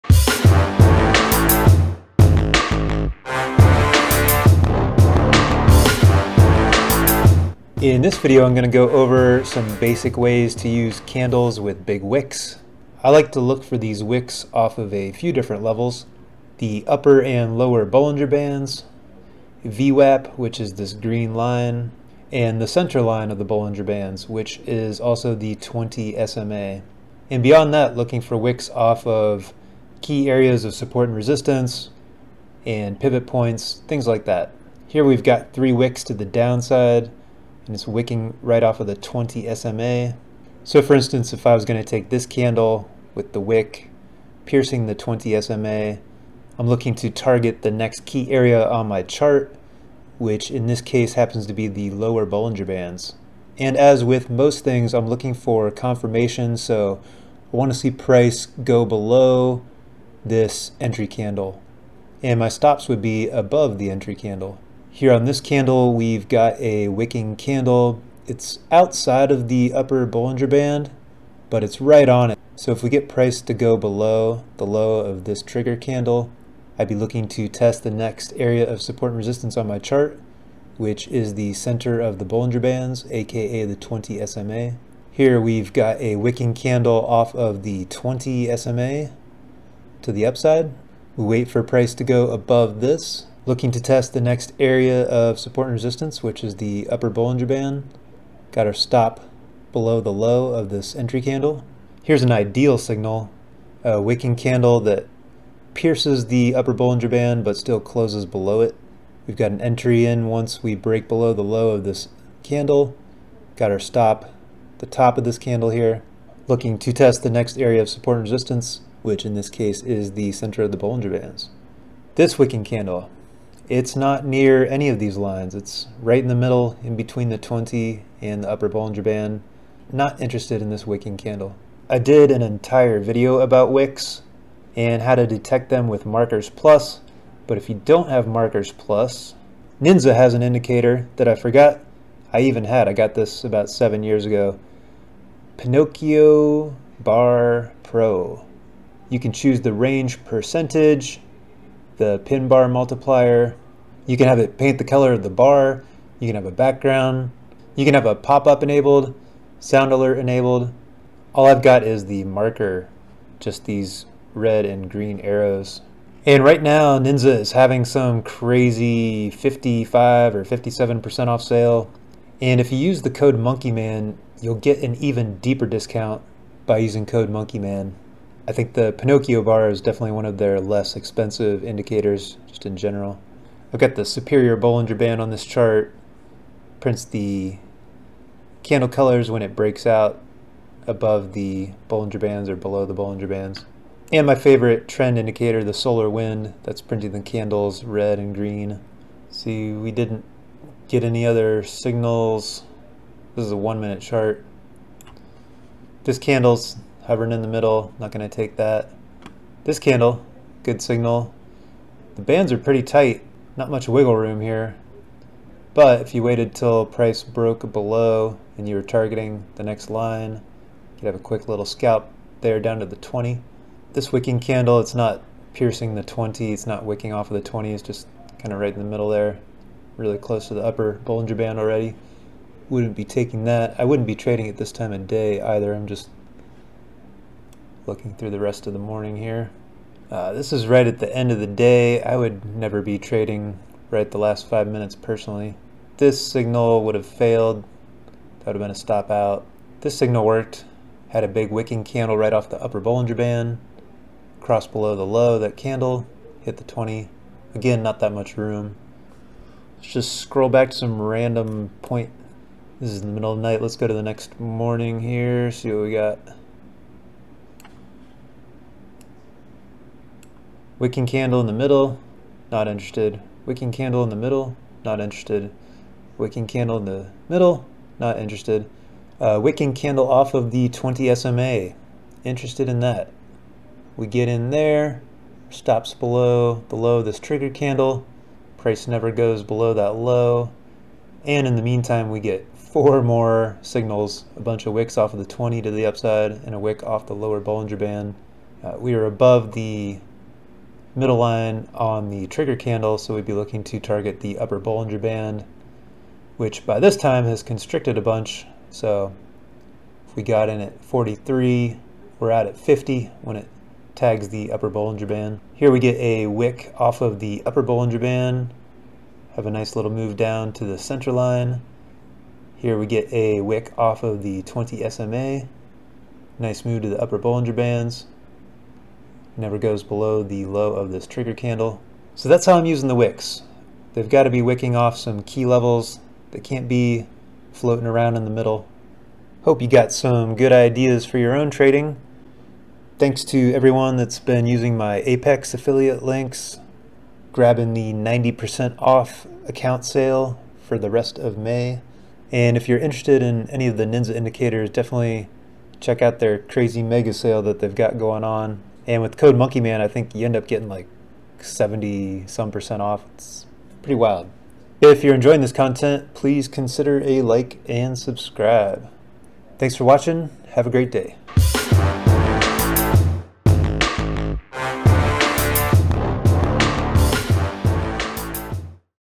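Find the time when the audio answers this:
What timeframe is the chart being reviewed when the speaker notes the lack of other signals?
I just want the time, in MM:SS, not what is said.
03:23.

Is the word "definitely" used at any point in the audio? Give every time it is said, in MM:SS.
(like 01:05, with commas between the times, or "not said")
02:59, 05:54.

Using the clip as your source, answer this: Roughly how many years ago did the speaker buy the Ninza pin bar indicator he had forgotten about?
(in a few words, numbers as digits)
7.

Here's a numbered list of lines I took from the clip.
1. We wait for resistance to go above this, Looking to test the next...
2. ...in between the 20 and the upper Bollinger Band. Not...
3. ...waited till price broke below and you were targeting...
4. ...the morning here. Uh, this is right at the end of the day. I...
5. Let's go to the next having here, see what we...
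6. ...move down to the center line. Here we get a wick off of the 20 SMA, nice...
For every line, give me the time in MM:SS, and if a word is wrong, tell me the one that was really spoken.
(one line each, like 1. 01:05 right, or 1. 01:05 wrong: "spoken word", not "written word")
1. 01:31 wrong: "price", not "resistance"
2. 02:06 right
3. 03:36 right
4. 03:58 right
5. 04:23 wrong: "morning", not "having"
6. 05:19 right.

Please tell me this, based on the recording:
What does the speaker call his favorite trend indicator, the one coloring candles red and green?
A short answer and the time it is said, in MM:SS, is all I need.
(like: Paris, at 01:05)
solar wind, at 03:15.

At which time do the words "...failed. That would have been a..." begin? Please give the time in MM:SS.
04:07.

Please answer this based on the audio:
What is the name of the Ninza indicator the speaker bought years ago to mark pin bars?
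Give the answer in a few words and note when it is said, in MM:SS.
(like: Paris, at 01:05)
Pinocchio Bar Pro, at 02:25.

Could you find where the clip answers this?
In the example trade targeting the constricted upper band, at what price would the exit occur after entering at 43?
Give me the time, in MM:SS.
05:12.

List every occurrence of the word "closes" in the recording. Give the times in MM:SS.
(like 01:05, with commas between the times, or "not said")
01:47, 03:50.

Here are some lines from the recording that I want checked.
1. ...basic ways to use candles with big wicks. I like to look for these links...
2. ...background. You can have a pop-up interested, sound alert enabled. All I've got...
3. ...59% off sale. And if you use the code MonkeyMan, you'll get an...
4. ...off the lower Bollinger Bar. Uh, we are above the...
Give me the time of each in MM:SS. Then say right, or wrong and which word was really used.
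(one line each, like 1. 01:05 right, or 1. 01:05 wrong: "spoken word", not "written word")
1. 00:09 wrong: "wicks", not "links"
2. 02:36 wrong: "enabled", not "interested"
3. 02:50 wrong: "57", not "59"
4. 04:56 wrong: "Band", not "Bar".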